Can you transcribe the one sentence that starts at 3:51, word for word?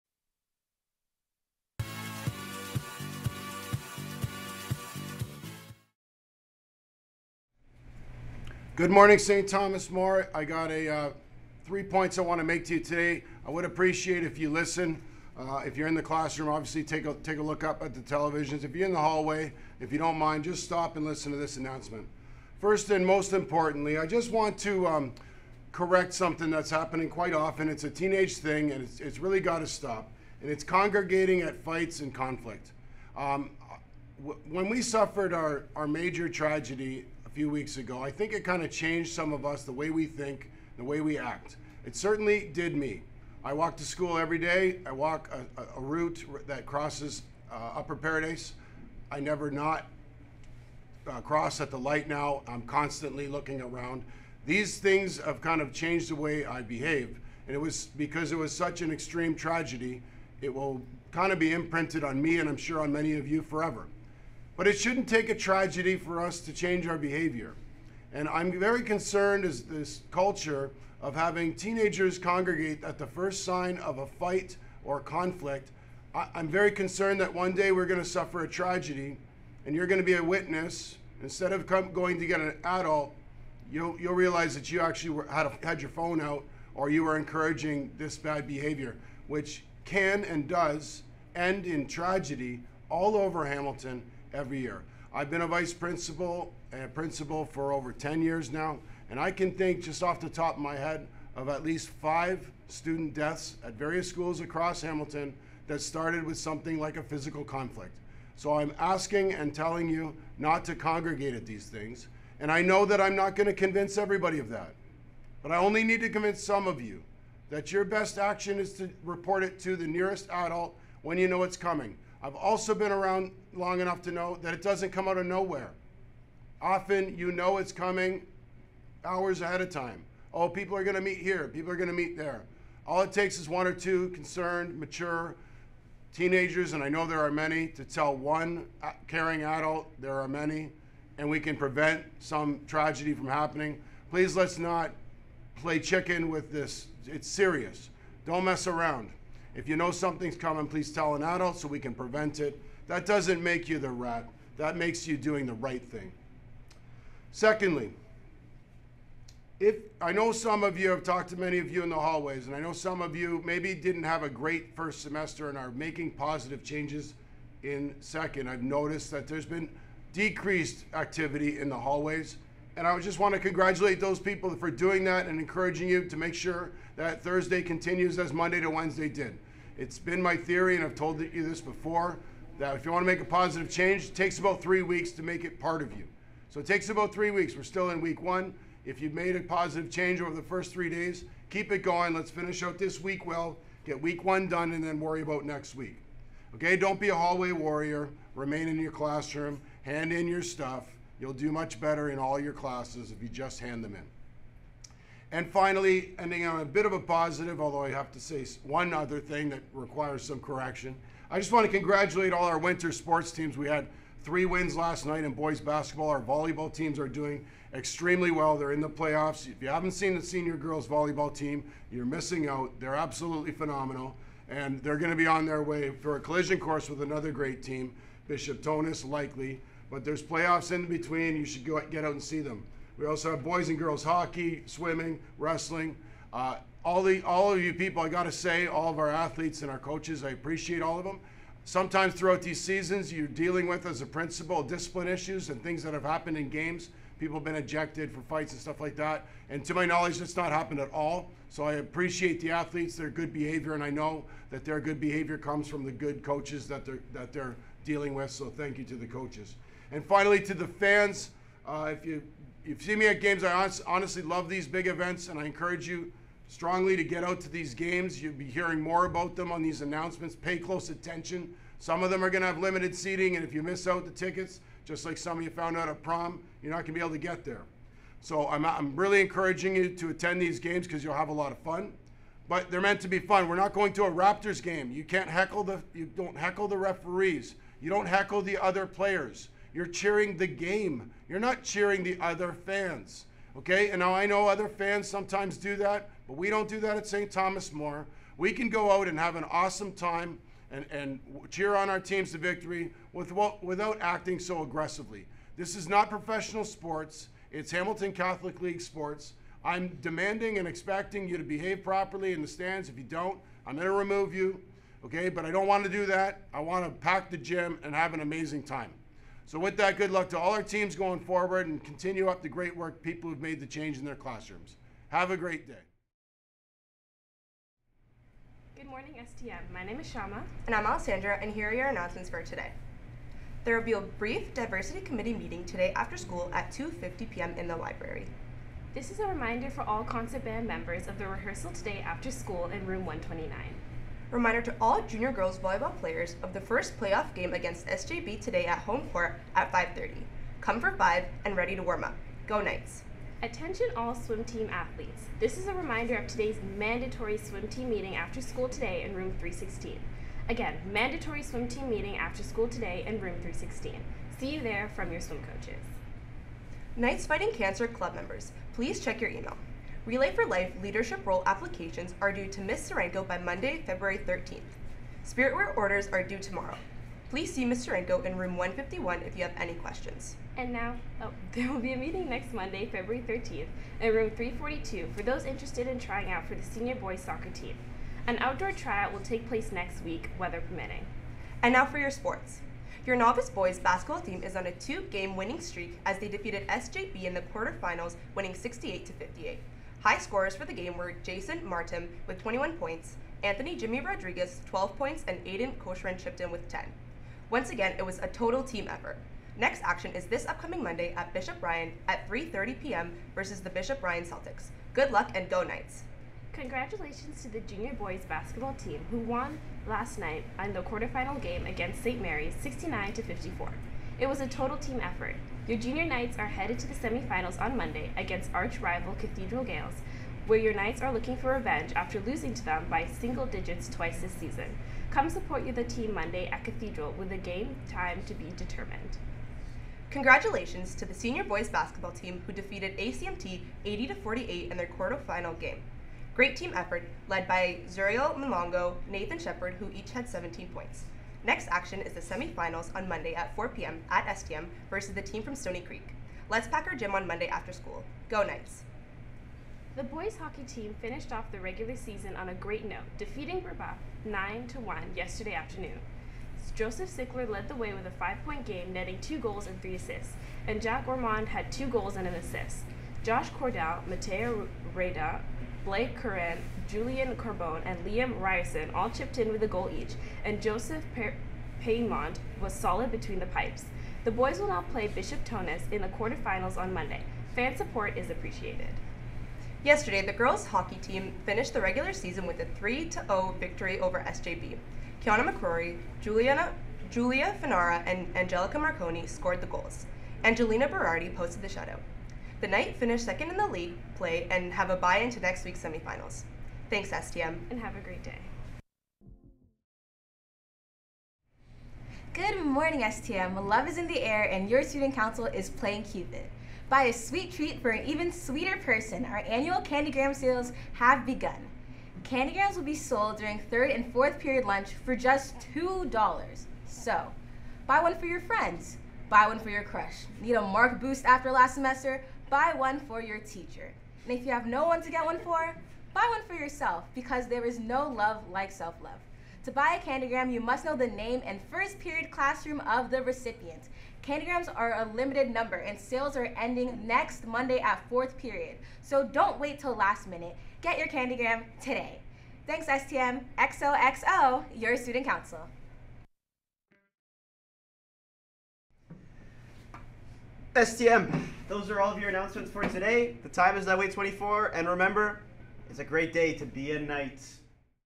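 You should go get out and see them.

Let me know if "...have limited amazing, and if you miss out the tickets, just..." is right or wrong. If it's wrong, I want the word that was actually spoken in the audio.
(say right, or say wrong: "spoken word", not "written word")
wrong: "seating", not "amazing".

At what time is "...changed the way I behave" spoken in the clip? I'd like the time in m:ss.
0:55.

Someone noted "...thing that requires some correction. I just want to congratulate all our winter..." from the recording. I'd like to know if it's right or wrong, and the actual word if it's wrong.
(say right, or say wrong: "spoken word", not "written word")
right.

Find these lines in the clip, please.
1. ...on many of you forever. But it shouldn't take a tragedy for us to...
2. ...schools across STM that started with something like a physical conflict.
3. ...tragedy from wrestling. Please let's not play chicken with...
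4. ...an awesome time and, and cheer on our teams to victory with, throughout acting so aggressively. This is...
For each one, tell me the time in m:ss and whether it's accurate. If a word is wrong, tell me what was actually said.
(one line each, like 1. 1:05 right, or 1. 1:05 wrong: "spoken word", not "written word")
1. 1:02 right
2. 1:44 wrong: "Hamilton", not "STM"
3. 2:22 wrong: "happening", not "wrestling"
4. 4:59 wrong: "without", not "throughout".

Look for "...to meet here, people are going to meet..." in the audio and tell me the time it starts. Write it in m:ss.
2:10.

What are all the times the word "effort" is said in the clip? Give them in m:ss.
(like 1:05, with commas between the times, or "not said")
6:48, 7:05, 7:26.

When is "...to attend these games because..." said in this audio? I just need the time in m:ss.
4:39.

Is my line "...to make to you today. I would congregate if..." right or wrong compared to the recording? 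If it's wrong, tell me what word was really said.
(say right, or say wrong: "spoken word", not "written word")
wrong: "appreciate", not "congregate".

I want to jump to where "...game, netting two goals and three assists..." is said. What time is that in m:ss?
7:48.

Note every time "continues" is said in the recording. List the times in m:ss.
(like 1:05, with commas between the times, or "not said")
2:57, 5:21.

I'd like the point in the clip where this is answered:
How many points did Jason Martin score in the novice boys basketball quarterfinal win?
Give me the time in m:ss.
6:42.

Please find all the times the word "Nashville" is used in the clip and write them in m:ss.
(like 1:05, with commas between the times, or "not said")
not said.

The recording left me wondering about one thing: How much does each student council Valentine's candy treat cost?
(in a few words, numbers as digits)
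$2.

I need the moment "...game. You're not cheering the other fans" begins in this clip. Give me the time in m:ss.
4:50.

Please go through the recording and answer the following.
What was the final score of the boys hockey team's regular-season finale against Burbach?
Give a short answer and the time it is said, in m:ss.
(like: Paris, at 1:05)
9 to 1, at 7:44.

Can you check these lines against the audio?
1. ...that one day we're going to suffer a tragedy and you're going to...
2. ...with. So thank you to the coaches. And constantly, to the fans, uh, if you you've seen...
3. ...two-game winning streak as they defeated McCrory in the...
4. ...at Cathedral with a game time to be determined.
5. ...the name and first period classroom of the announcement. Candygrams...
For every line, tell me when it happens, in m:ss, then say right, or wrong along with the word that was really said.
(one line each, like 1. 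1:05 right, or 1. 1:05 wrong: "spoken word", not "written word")
1. 1:17 right
2. 4:18 wrong: "finally", not "constantly"
3. 6:34 wrong: "SJB", not "McCrory"
4. 7:16 right
5. 9:00 wrong: "recipient", not "announcement".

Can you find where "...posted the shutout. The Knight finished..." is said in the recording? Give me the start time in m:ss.
8:21.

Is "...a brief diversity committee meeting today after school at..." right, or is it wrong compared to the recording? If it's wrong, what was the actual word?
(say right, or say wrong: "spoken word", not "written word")
right.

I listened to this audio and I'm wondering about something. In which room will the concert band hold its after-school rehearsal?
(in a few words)
Room 129.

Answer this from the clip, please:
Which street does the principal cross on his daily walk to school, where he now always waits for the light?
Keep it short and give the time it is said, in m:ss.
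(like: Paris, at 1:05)
Upper Paradise, at 0:47.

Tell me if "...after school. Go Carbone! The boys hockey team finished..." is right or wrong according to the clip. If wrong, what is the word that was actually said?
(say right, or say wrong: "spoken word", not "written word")
wrong: "Knights", not "Carbone".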